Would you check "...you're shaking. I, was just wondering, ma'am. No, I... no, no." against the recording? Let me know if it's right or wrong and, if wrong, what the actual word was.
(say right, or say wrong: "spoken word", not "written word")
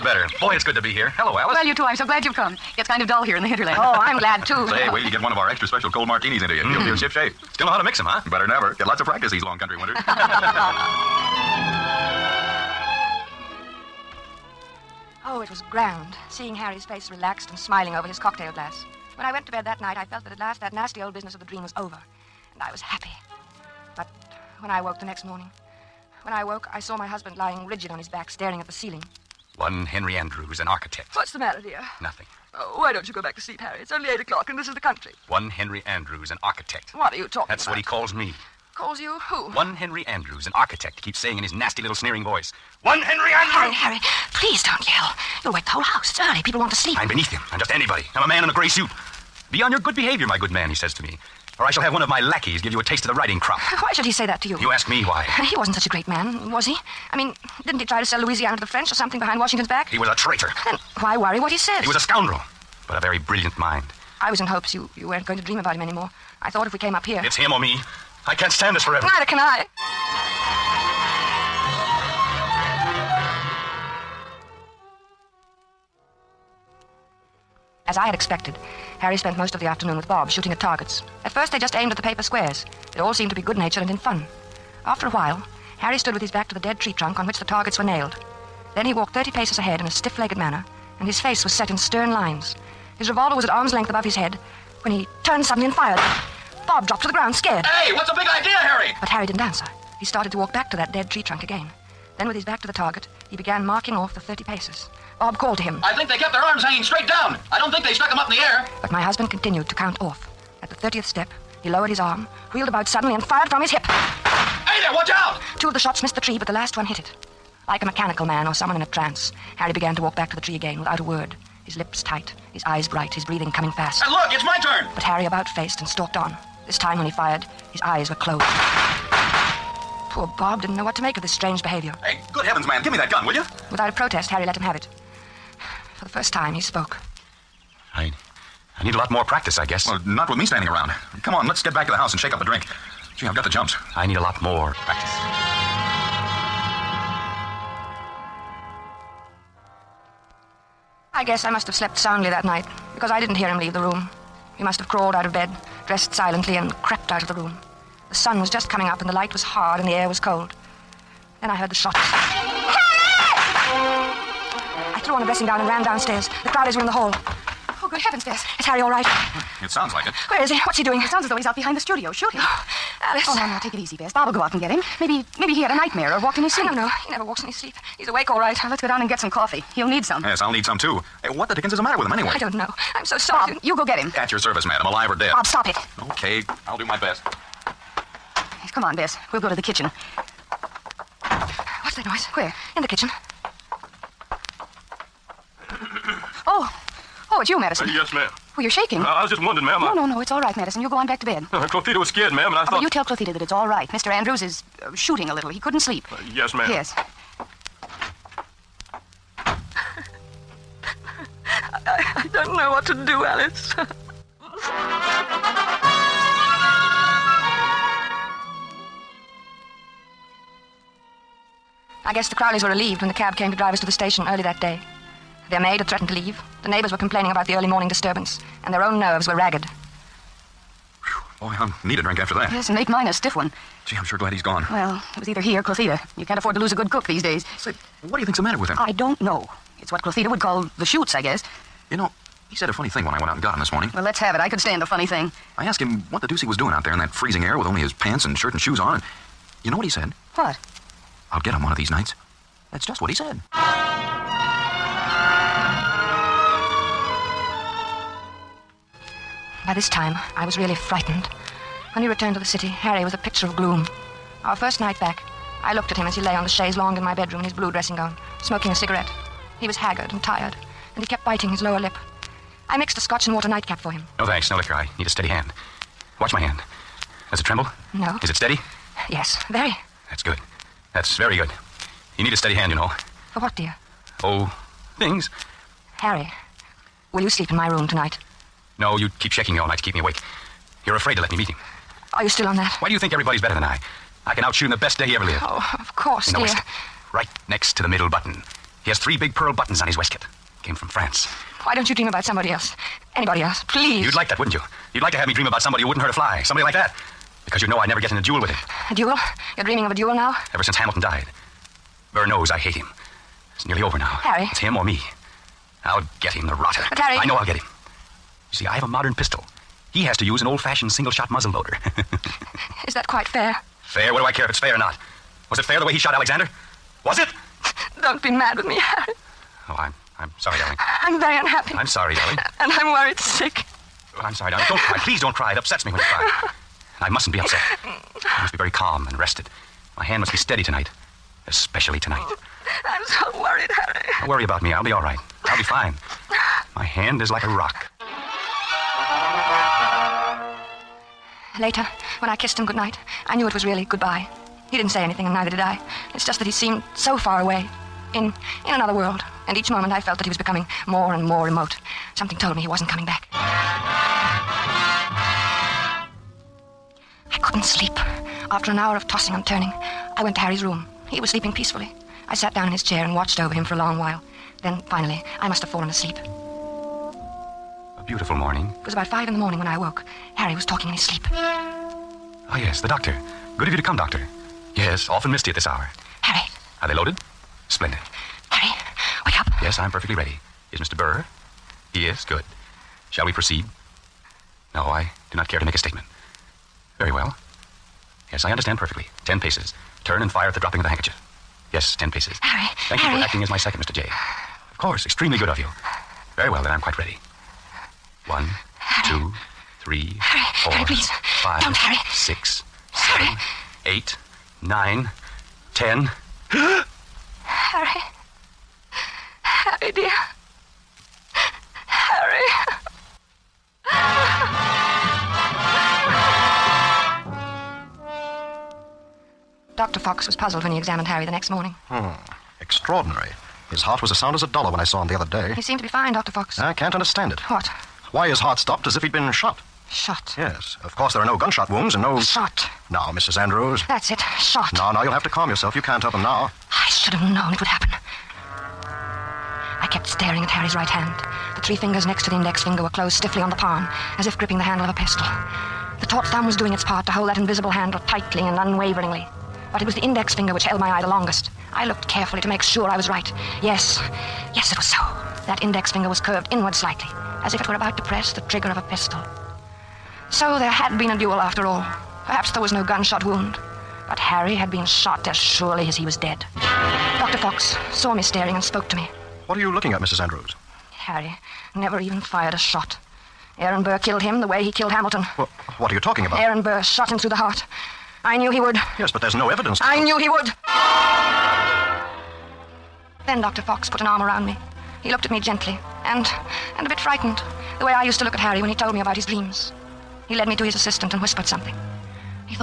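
right.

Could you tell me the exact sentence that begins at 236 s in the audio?
You can't afford to lose a good cook these days.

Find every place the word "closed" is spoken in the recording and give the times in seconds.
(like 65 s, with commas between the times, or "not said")
128 s, 452 s.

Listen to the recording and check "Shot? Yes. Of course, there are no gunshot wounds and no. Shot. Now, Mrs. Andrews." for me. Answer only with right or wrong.
right.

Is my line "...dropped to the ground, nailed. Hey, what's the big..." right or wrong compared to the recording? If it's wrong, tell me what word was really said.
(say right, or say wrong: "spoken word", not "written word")
wrong: "scared", not "nailed".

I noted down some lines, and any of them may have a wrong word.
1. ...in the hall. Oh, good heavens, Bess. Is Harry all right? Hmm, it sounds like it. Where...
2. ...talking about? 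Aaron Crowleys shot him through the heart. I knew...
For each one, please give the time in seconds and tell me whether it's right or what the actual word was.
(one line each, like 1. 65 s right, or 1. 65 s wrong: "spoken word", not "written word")
1. 166 s right
2. 485 s wrong: "Burr", not "Crowleys".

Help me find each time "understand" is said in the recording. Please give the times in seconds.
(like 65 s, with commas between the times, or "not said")
398 s, 436 s.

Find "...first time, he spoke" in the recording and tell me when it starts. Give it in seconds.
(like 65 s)
136 s.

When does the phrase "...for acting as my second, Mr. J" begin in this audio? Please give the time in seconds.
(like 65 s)
403 s.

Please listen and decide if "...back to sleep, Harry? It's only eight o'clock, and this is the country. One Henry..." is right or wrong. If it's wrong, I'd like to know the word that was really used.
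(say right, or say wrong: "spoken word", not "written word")
right.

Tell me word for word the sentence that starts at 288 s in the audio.
No, you keep shaking me all night to keep me awake.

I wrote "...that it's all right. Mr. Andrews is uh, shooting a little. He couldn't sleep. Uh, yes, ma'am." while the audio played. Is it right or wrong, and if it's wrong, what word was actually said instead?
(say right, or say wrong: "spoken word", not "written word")
right.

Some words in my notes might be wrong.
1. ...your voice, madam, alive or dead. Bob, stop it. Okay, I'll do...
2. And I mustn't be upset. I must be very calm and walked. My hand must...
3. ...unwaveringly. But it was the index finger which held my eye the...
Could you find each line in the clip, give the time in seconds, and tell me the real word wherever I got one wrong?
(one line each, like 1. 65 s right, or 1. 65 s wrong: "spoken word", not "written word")
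1. 184 s wrong: "service", not "voice"
2. 336 s wrong: "rested", not "walked"
3. 458 s right.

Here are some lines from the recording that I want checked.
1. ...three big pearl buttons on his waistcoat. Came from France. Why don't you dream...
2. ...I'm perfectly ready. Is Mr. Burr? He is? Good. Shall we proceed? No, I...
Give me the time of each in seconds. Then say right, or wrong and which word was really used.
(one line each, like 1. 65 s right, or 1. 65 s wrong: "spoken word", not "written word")
1. 298 s right
2. 389 s right.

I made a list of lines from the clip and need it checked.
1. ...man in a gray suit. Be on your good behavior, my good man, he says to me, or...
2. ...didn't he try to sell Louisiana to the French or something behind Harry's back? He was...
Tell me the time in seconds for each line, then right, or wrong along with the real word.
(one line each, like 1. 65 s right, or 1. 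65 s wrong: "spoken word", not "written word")
1. 48 s right
2. 57 s wrong: "Washington", not "Harry".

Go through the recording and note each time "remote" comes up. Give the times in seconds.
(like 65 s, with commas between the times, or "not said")
361 s.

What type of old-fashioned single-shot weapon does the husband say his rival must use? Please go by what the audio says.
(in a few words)
Muzzle loader.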